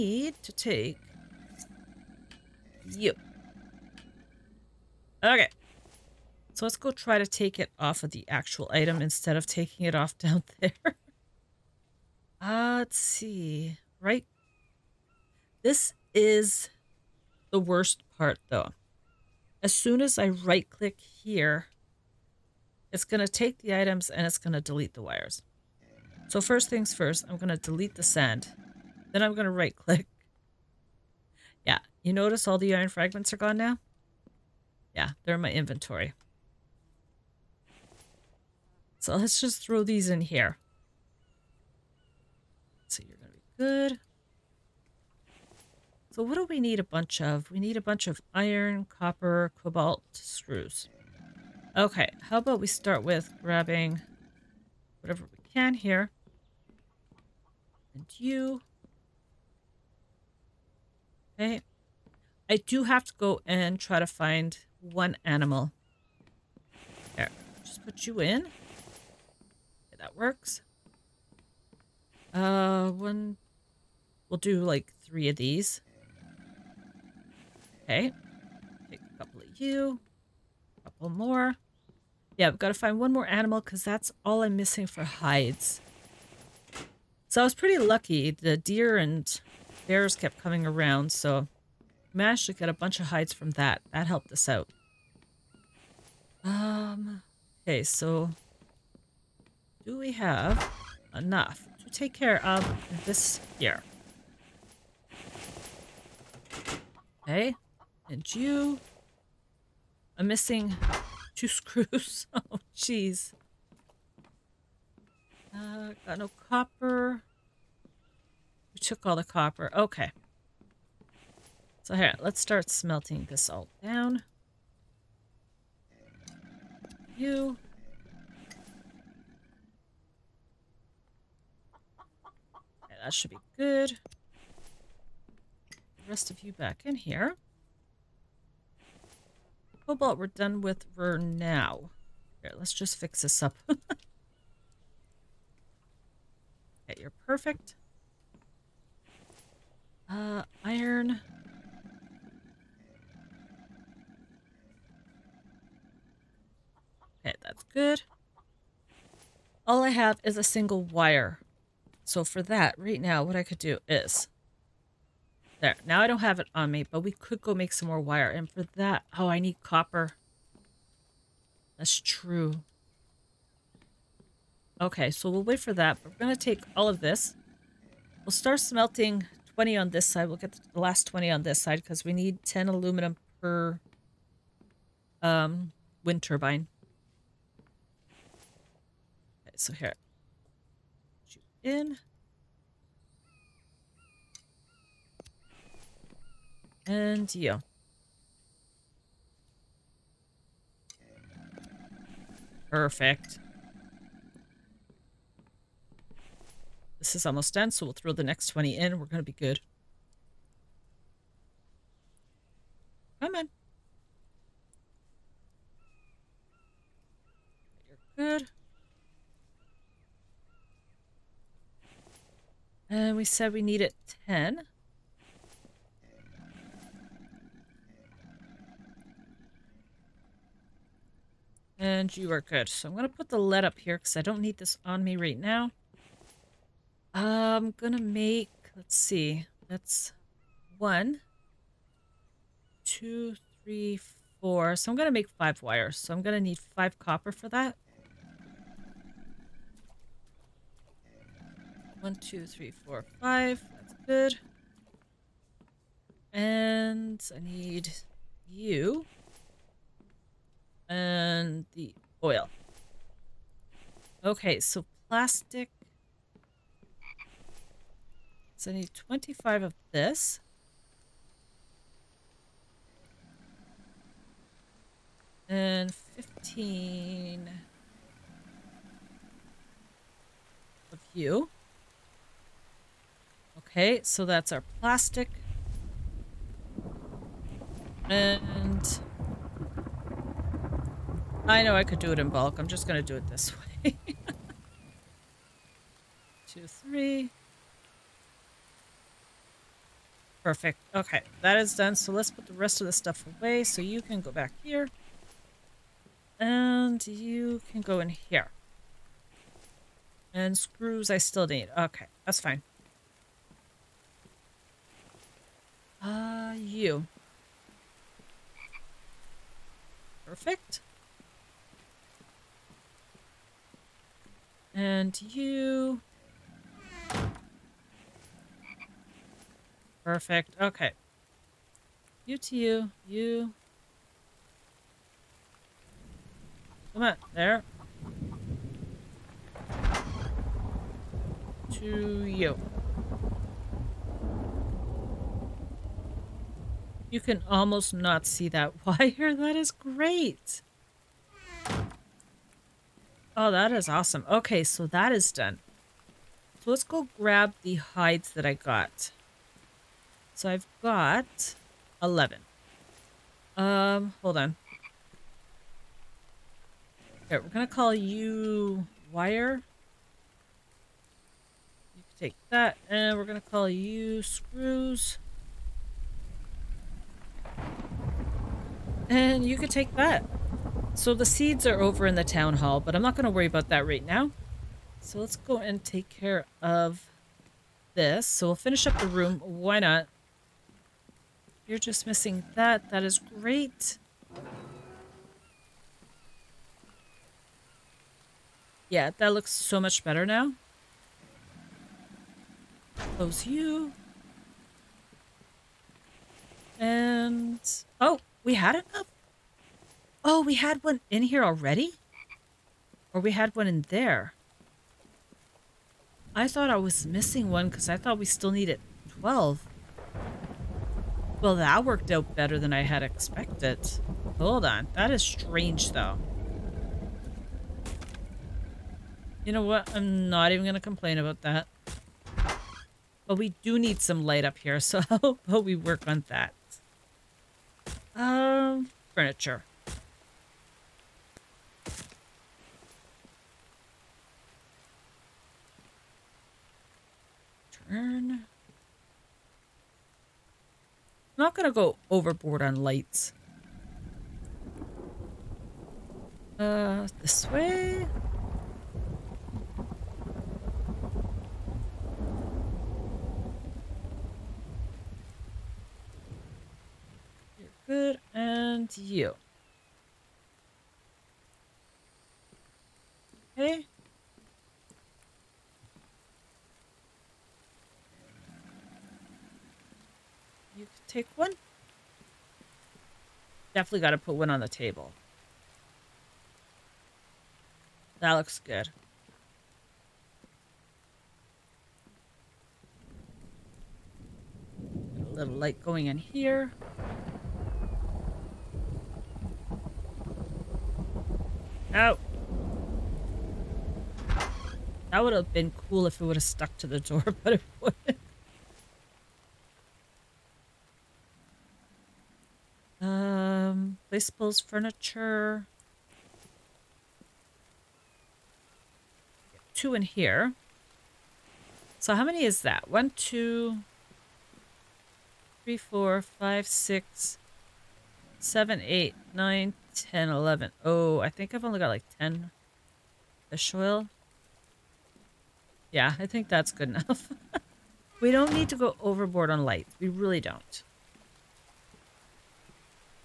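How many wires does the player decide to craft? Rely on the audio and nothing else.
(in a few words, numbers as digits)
5.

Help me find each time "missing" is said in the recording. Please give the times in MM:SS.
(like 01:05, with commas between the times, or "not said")
01:24, 01:50, 06:32, 06:57.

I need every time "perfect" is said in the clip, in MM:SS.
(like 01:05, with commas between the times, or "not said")
02:27, 03:22, 05:00, 05:20, 05:30.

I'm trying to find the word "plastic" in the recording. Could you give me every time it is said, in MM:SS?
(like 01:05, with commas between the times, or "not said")
04:25, 04:44.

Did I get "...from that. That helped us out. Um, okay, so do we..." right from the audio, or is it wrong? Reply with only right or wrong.
right.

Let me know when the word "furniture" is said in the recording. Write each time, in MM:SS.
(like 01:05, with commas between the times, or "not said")
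07:19, 08:34.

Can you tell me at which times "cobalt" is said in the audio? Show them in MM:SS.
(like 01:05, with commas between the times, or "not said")
00:49, 02:19.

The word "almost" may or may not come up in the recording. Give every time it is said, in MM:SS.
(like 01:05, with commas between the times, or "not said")
03:27, 05:47.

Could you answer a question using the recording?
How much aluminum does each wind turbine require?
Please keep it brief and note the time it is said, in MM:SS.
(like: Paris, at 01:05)
10, at 03:02.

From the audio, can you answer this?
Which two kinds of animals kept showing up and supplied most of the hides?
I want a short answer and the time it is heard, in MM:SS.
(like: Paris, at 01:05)
deer and bears, at 01:28.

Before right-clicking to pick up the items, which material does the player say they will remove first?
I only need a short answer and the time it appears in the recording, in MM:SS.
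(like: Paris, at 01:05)
sand, at 00:27.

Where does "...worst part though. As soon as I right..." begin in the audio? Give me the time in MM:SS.
00:17.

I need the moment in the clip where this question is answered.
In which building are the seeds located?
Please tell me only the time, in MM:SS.
06:22.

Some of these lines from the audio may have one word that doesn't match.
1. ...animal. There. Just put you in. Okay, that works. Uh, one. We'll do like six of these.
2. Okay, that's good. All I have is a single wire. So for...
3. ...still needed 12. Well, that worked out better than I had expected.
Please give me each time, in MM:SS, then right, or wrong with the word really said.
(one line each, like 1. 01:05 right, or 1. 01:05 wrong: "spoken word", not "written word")
1. 01:05 wrong: "three", not "six"
2. 02:37 right
3. 06:58 right.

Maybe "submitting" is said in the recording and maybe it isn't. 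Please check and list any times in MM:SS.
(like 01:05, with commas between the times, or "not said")
not said.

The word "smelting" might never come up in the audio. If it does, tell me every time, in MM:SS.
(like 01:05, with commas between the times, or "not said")
02:02, 02:58.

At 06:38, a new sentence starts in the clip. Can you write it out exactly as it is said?
Yeah, that looks so much better now.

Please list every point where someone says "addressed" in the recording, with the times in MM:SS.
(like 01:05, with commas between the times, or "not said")
not said.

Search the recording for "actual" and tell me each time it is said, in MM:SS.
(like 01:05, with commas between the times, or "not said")
00:08.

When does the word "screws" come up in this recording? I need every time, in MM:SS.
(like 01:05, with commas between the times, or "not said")
00:50, 01:51, 05:10, 06:14.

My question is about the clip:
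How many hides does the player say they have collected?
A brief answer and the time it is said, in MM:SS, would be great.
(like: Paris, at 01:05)
11, at 06:00.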